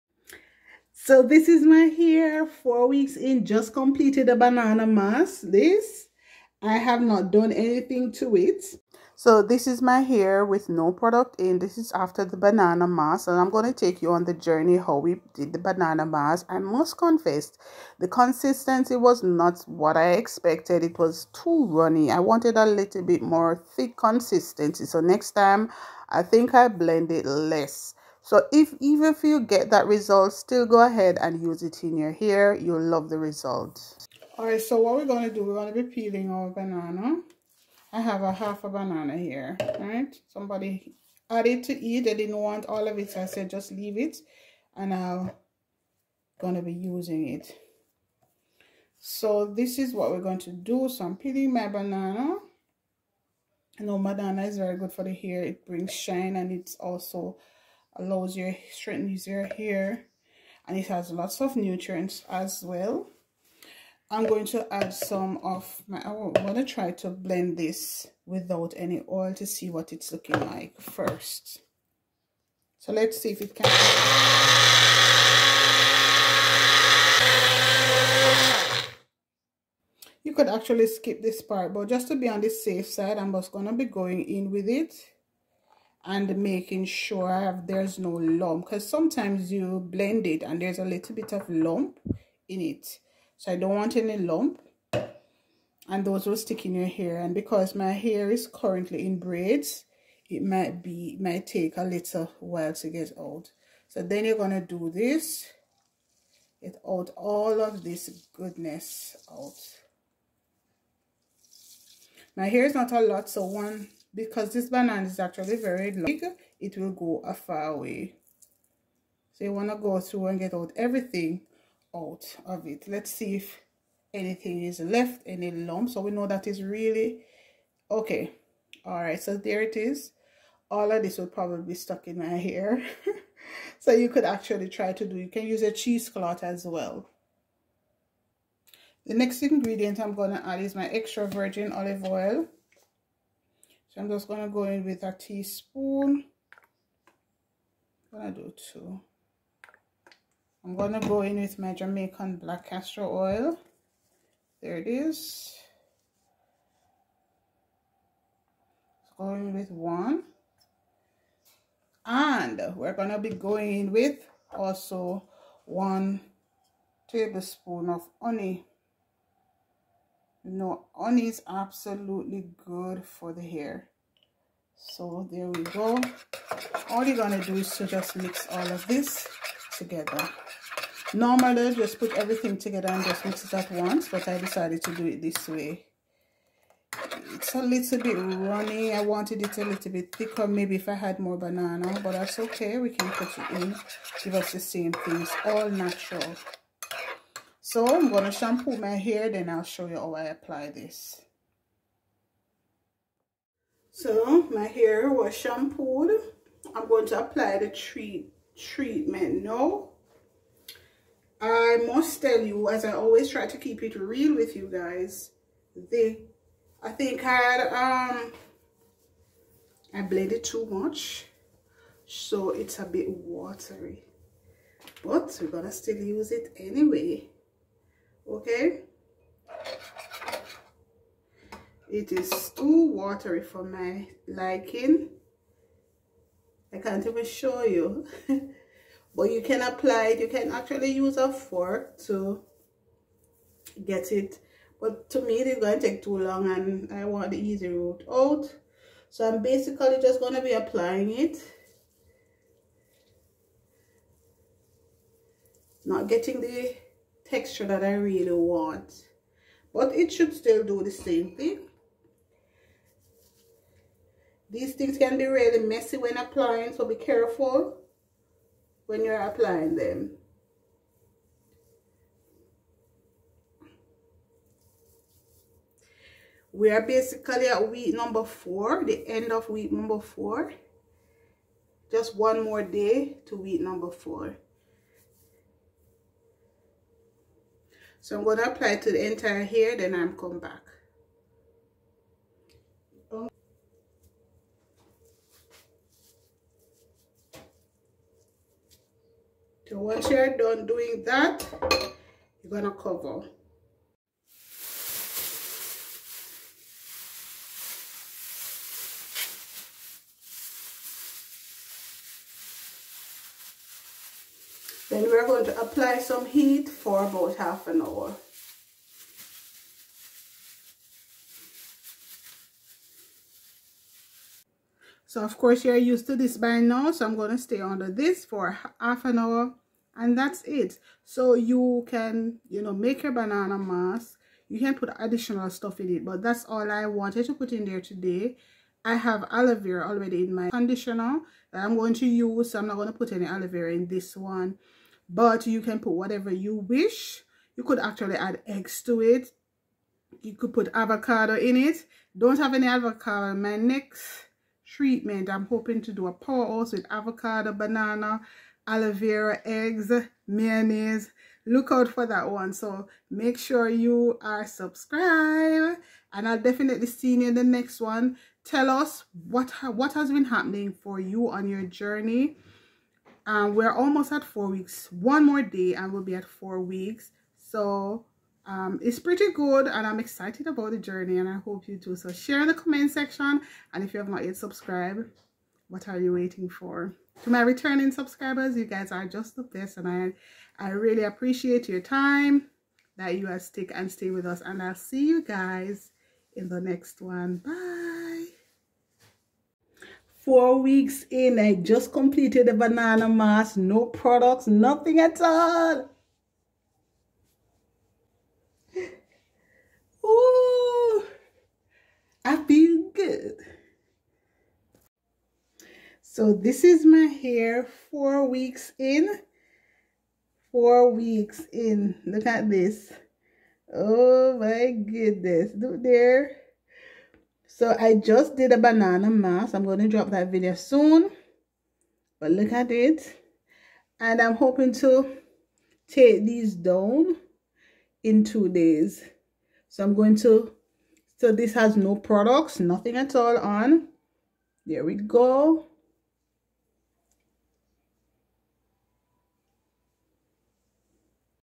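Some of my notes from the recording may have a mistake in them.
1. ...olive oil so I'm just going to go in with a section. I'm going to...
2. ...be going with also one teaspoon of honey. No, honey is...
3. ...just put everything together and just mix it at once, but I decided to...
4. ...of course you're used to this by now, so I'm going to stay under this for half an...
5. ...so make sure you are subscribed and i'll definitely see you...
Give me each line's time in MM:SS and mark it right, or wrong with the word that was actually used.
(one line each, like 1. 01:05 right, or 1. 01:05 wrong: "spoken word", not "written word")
1. 02:21 wrong: "teaspoon", not "section"
2. 02:43 wrong: "tablespoon", not "teaspoon"
3. 03:01 right
4. 05:25 right
5. 06:02 right.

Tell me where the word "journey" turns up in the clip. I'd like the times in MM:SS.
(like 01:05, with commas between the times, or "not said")
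00:14, 06:11, 06:20.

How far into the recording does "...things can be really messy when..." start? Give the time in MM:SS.
04:24.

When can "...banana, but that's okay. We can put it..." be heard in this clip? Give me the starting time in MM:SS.
03:11.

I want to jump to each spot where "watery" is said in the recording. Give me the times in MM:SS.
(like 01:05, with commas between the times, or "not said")
03:43, 03:52.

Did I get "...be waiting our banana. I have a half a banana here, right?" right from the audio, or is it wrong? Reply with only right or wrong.
wrong.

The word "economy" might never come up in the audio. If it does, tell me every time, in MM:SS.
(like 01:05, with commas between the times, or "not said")
not said.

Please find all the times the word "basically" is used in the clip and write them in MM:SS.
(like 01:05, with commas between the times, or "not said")
04:09, 04:36.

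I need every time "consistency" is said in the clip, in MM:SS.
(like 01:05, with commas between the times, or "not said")
00:18, 00:23.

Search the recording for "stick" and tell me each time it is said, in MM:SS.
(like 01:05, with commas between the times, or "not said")
01:36, 06:33.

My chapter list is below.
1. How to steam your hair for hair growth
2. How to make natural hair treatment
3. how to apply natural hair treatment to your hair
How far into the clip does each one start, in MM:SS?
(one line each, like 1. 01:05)
1. 05:29
2. 01:09
3. 03:53.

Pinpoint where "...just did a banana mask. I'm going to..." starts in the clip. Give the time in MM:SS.
07:07.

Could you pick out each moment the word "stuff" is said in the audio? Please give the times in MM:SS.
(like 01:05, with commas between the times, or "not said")
05:35.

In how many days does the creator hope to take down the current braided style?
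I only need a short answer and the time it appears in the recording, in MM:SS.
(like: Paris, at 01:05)
2, at 07:18.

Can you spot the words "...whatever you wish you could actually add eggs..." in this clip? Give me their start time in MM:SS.
05:45.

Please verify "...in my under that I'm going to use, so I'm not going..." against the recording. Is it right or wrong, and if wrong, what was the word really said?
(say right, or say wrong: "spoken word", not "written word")
wrong: "conditioner", not "under".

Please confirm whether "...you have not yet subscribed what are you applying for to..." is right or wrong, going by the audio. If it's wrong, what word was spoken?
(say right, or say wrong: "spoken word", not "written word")
wrong: "waiting", not "applying".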